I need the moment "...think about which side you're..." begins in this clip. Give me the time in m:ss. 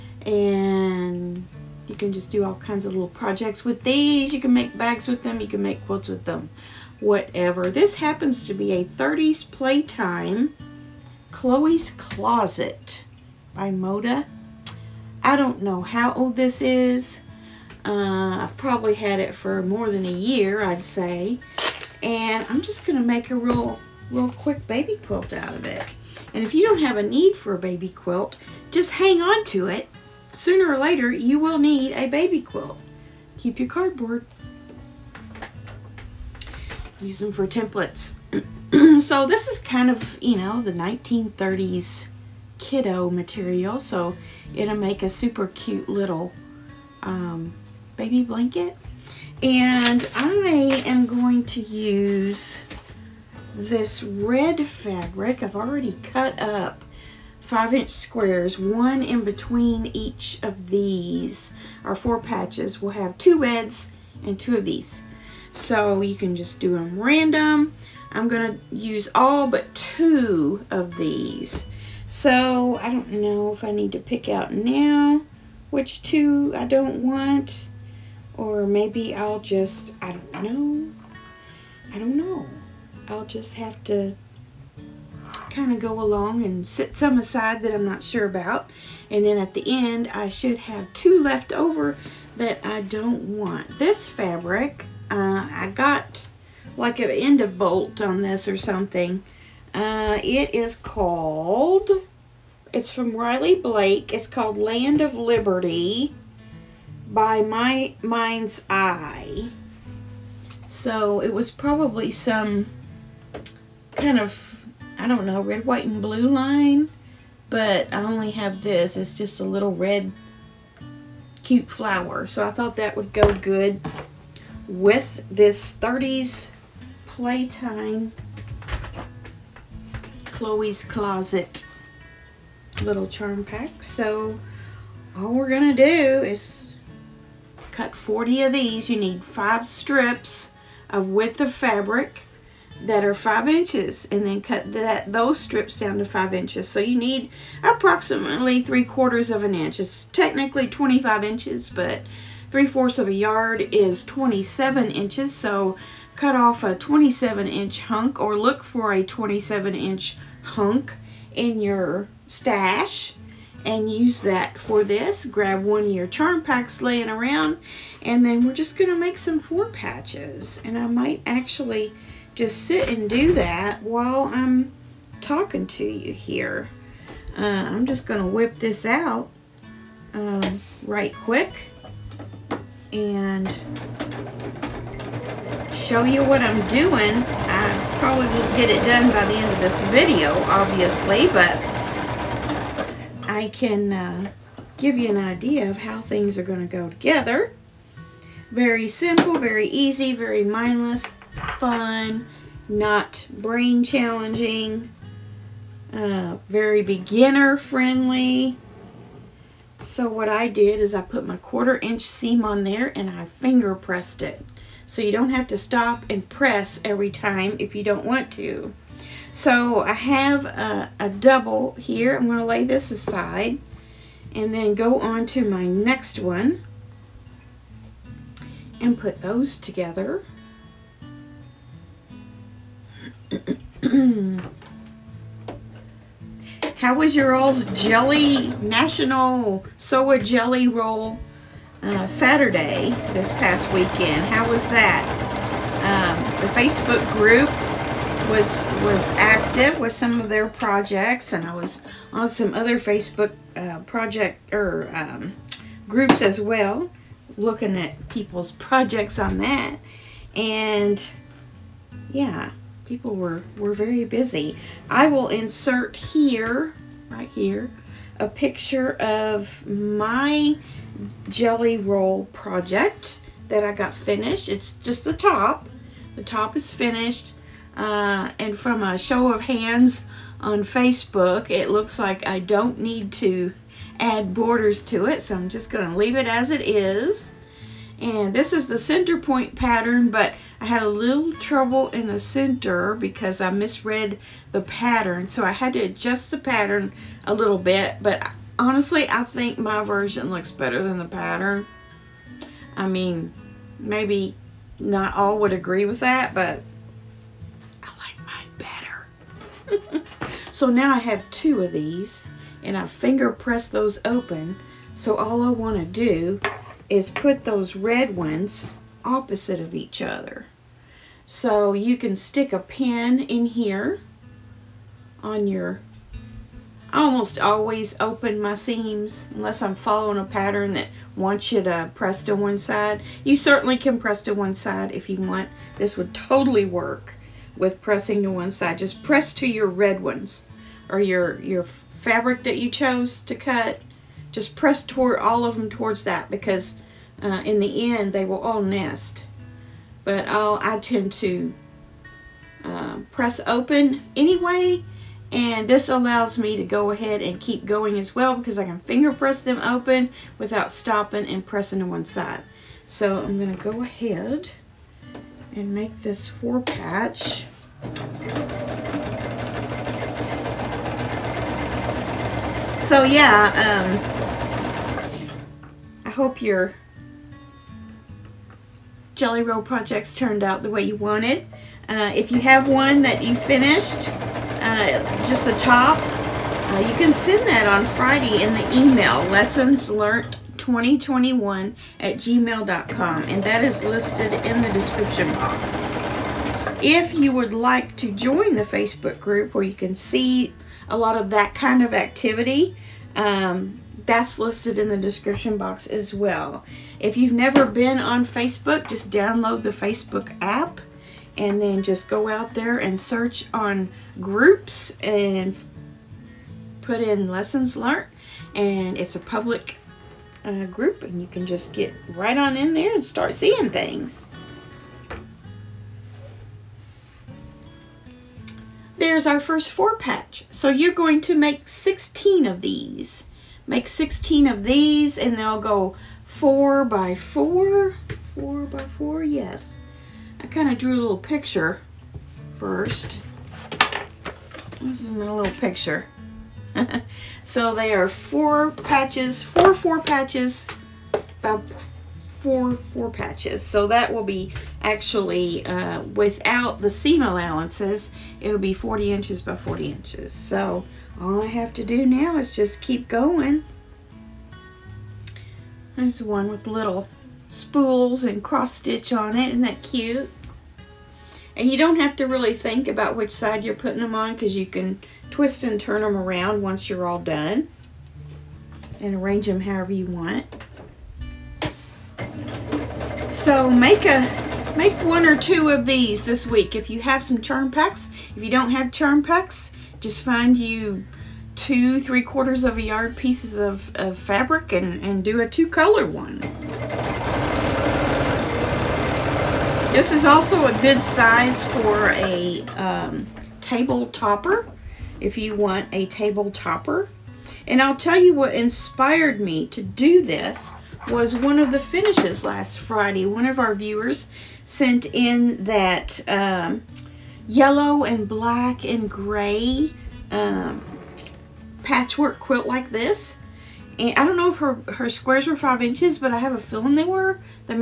7:52.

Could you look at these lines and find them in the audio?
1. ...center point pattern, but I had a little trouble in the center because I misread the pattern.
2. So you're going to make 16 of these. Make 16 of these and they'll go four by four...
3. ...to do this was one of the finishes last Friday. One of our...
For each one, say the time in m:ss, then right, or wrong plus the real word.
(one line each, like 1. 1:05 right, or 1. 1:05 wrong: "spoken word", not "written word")
1. 4:48 right
2. 7:10 right
3. 8:29 right.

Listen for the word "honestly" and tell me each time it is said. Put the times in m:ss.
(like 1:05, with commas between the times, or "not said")
4:58.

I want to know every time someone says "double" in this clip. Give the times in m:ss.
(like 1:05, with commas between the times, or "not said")
3:41.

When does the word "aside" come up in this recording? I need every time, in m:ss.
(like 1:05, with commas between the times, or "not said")
1:27, 3:42.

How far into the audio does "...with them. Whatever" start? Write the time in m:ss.
0:06.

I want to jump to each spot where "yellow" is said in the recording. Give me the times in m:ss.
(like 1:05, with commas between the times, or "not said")
8:37.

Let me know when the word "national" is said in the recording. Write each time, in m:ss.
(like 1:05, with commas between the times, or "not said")
3:58.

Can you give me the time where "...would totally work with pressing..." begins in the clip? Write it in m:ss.
5:35.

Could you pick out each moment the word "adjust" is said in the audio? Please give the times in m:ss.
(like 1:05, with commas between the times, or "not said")
4:55.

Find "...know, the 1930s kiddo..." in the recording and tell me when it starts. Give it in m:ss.
0:40.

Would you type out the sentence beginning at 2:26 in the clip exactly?
So you need approximately three quarters of an inch.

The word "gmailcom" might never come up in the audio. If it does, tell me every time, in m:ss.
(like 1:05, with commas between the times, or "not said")
6:32.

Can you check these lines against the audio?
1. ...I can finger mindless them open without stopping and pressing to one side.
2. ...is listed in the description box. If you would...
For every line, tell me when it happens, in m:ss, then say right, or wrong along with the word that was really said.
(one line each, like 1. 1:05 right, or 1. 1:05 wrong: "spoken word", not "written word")
1. 5:58 wrong: "press", not "mindless"
2. 6:33 right.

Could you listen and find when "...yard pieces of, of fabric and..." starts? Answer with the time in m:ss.
8:12.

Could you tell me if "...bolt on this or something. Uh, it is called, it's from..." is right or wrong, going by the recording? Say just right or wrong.
right.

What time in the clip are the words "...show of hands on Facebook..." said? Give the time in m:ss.
4:38.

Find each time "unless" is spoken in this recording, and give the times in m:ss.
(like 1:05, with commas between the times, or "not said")
5:29.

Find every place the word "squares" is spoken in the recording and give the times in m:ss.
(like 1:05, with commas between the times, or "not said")
0:57, 8:45.